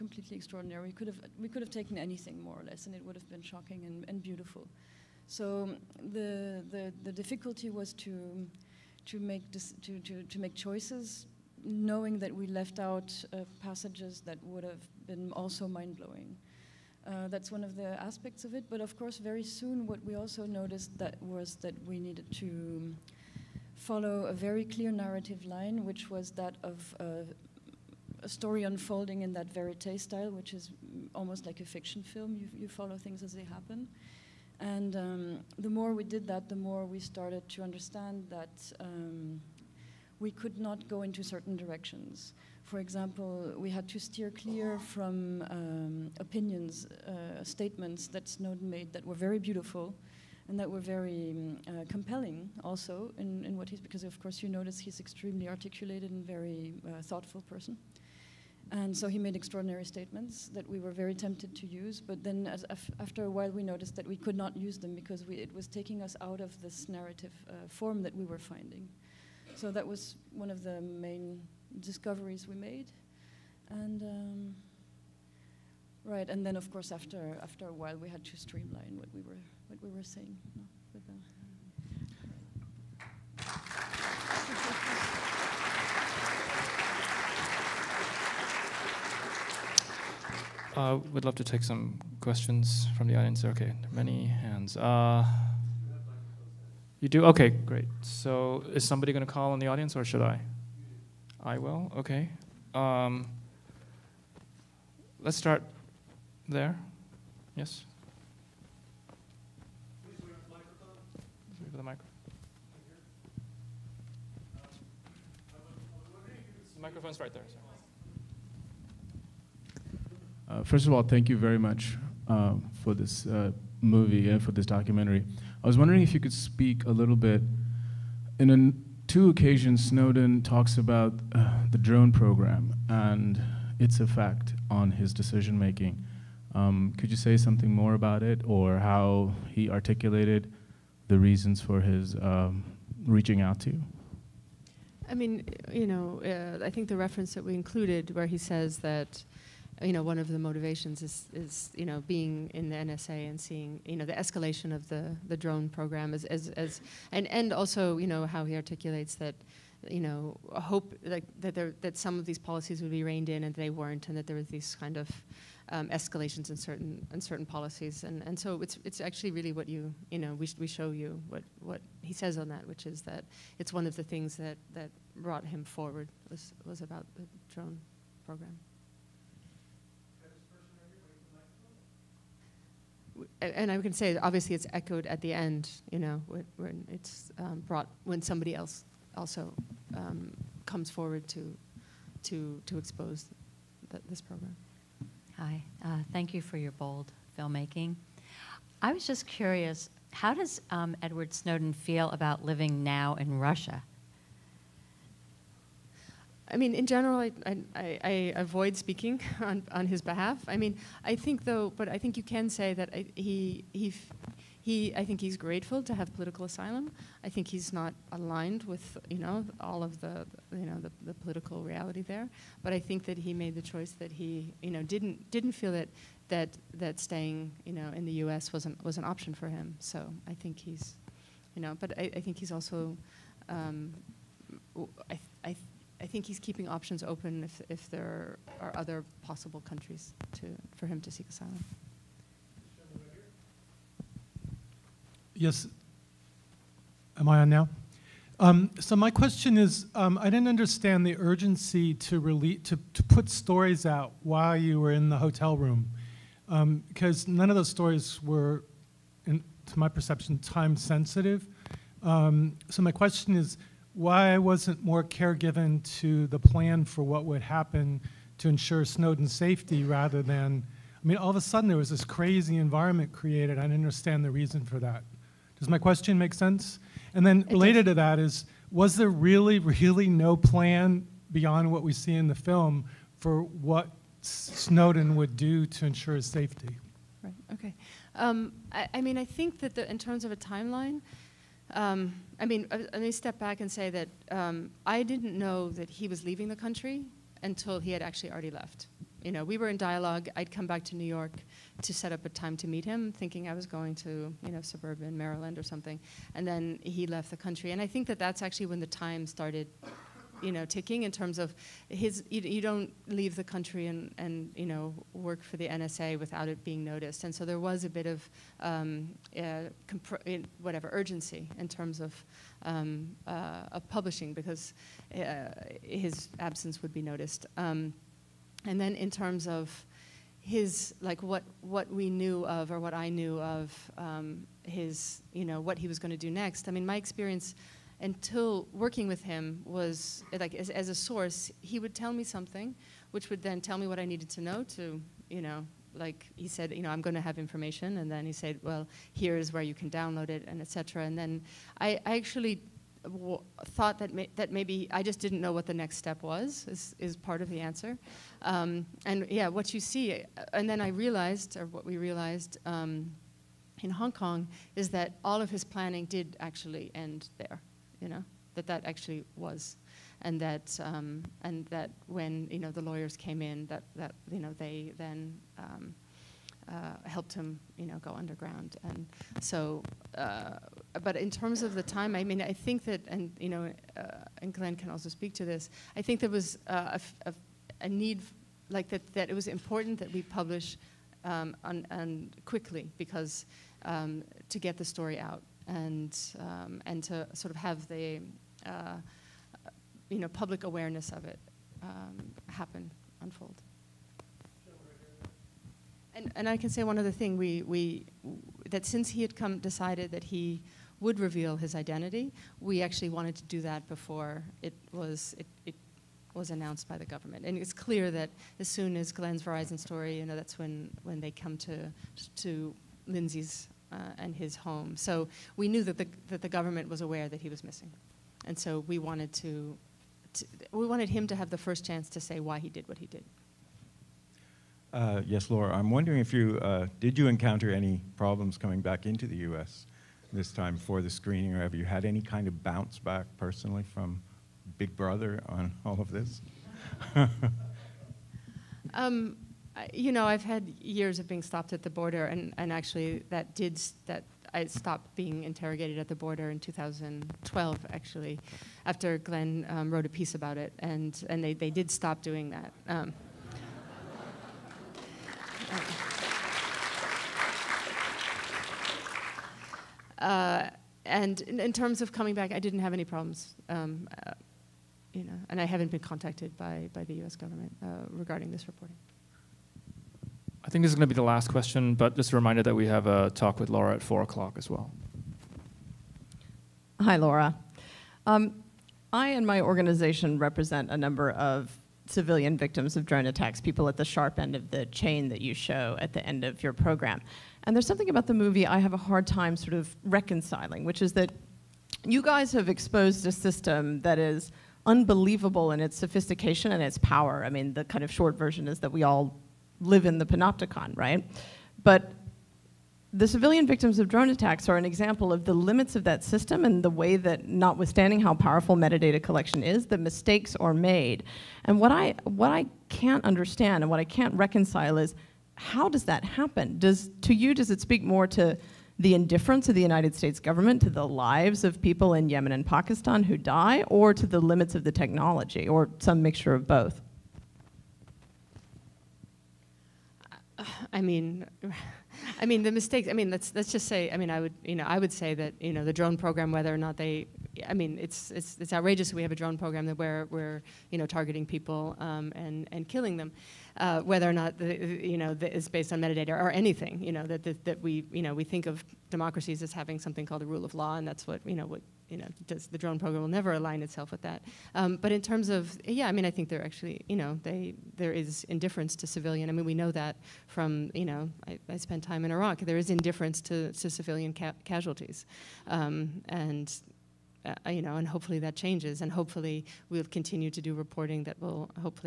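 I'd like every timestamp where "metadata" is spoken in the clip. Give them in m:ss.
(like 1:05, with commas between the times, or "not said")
8:38, 9:15.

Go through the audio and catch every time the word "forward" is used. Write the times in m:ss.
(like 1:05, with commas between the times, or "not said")
2:55, 3:10.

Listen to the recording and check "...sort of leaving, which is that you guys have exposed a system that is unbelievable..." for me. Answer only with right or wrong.
wrong.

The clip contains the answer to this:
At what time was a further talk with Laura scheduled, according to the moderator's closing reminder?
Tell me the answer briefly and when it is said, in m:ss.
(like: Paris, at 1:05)
4 o'clock, at 8:04.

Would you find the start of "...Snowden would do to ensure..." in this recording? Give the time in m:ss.
4:44.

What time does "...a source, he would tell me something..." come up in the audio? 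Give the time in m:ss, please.
5:40.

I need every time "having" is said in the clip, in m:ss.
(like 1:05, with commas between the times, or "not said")
9:19.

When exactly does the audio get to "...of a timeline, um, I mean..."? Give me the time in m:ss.
4:50.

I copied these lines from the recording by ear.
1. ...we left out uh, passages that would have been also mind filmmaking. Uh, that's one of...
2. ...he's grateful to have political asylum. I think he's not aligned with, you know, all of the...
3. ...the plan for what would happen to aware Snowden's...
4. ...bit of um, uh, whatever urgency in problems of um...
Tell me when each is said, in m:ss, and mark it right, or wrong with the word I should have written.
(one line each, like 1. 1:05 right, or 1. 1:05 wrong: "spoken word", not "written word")
1. 0:12 wrong: "blowing", not "filmmaking"
2. 3:35 right
3. 4:26 wrong: "ensure", not "aware"
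4. 5:17 wrong: "terms", not "problems".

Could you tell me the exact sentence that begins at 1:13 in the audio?
And um, right, and then of course after after a while we had to streamline what we were what we were saying.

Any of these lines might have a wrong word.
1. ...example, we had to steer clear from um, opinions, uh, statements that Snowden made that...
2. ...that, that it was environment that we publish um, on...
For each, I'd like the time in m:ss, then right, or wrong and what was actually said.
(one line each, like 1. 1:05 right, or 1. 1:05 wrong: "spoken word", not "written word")
1. 0:42 right
2. 6:28 wrong: "important", not "environment".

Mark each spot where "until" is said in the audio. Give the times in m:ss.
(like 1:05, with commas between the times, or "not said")
4:57, 5:38.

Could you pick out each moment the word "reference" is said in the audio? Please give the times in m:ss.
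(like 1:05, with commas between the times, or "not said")
2:26.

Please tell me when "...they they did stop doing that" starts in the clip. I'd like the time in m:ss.
7:41.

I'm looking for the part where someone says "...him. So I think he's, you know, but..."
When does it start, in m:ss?
3:49.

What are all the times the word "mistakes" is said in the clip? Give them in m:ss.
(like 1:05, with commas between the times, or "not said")
8:39, 9:02.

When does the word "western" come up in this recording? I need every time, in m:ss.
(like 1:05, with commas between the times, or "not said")
not said.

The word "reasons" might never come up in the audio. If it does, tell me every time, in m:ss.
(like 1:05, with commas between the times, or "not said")
2:21, 4:34.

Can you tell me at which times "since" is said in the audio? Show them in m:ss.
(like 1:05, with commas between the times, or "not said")
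6:48.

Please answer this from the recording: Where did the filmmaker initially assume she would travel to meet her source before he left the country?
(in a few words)
suburban Maryland.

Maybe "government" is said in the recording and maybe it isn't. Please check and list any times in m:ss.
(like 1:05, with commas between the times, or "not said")
6:57, 7:06, 7:57, 8:50.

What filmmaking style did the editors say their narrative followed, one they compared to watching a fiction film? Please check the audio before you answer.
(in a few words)
verite.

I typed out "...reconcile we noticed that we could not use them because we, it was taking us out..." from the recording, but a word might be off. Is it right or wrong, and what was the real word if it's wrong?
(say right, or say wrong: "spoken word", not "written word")
wrong: "while", not "reconcile".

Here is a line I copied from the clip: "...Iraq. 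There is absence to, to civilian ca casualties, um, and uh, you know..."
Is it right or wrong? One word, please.
wrong.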